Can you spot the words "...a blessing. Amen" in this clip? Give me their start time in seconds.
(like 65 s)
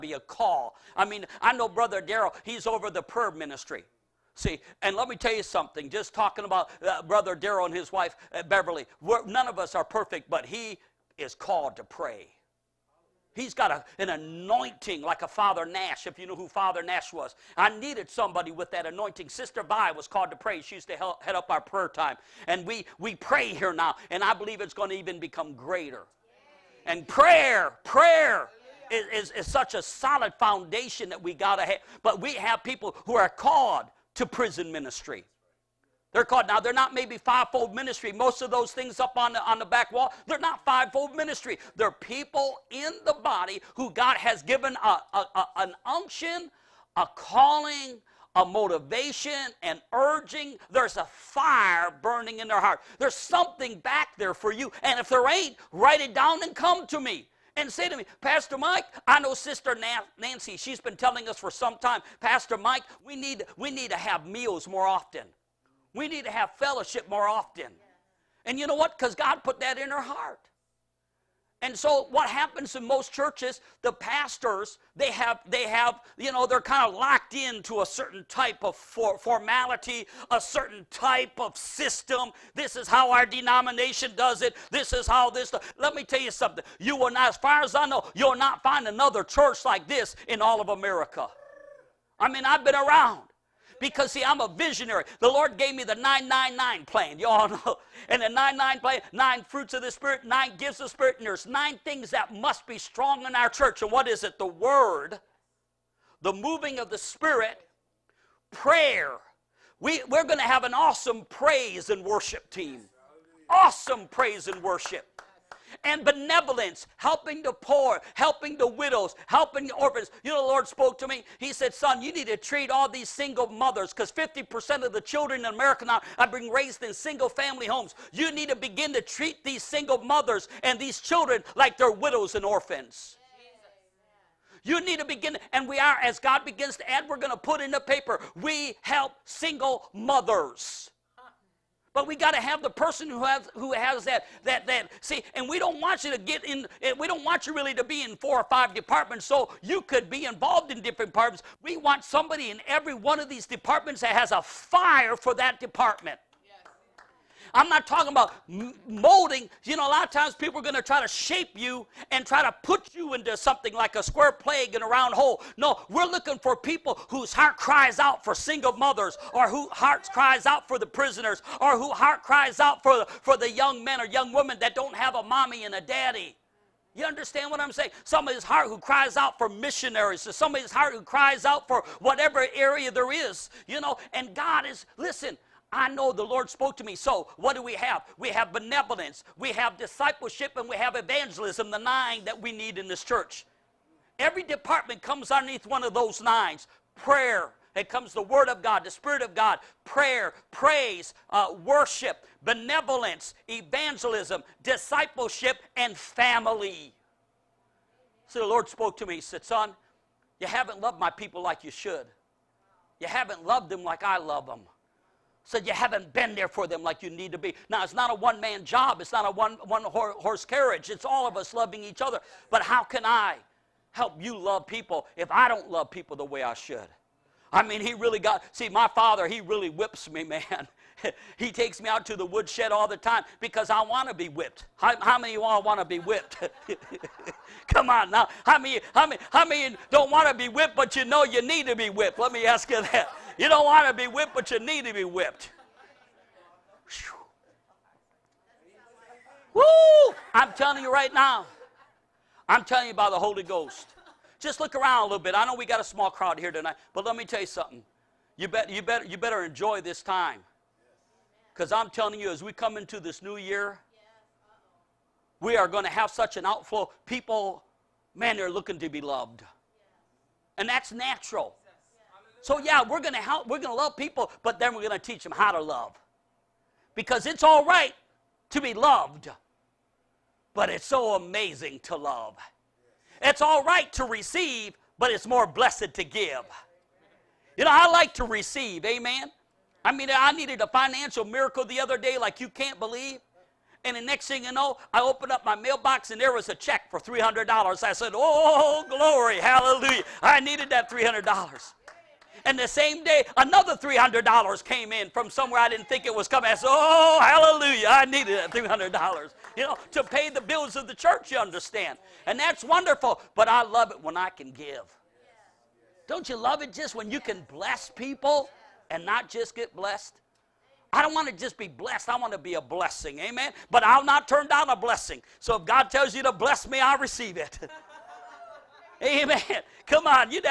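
322 s.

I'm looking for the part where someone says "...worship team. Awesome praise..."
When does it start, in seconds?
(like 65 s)
112 s.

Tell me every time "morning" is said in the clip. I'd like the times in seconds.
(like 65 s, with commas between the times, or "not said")
not said.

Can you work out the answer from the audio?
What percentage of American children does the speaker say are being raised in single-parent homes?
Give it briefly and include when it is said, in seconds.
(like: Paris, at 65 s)
50%, at 124 s.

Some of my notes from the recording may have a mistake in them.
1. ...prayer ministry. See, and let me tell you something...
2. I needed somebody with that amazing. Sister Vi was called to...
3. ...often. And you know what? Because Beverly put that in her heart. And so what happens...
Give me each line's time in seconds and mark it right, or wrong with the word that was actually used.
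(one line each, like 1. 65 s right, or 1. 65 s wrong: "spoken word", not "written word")
1. 3 s right
2. 17 s wrong: "anointing", not "amazing"
3. 67 s wrong: "God", not "Beverly".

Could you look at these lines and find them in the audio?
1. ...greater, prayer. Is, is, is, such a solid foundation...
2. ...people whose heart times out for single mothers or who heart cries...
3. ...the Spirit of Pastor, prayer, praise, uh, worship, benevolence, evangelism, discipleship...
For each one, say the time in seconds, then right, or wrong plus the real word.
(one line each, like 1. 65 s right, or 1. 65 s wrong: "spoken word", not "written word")
1. 27 s wrong: "prayer", not "greater"
2. 166 s wrong: "cries", not "times"
3. 198 s wrong: "God", not "Pastor".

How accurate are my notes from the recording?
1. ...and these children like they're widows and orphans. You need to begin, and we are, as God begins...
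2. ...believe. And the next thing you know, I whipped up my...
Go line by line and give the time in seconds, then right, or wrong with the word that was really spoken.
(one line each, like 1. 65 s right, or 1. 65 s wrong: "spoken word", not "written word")
1. 130 s right
2. 292 s wrong: "opened", not "whipped".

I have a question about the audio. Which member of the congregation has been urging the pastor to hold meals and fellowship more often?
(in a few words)
Sister Nancy.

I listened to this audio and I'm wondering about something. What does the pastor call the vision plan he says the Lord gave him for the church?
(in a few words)
The 999 plan.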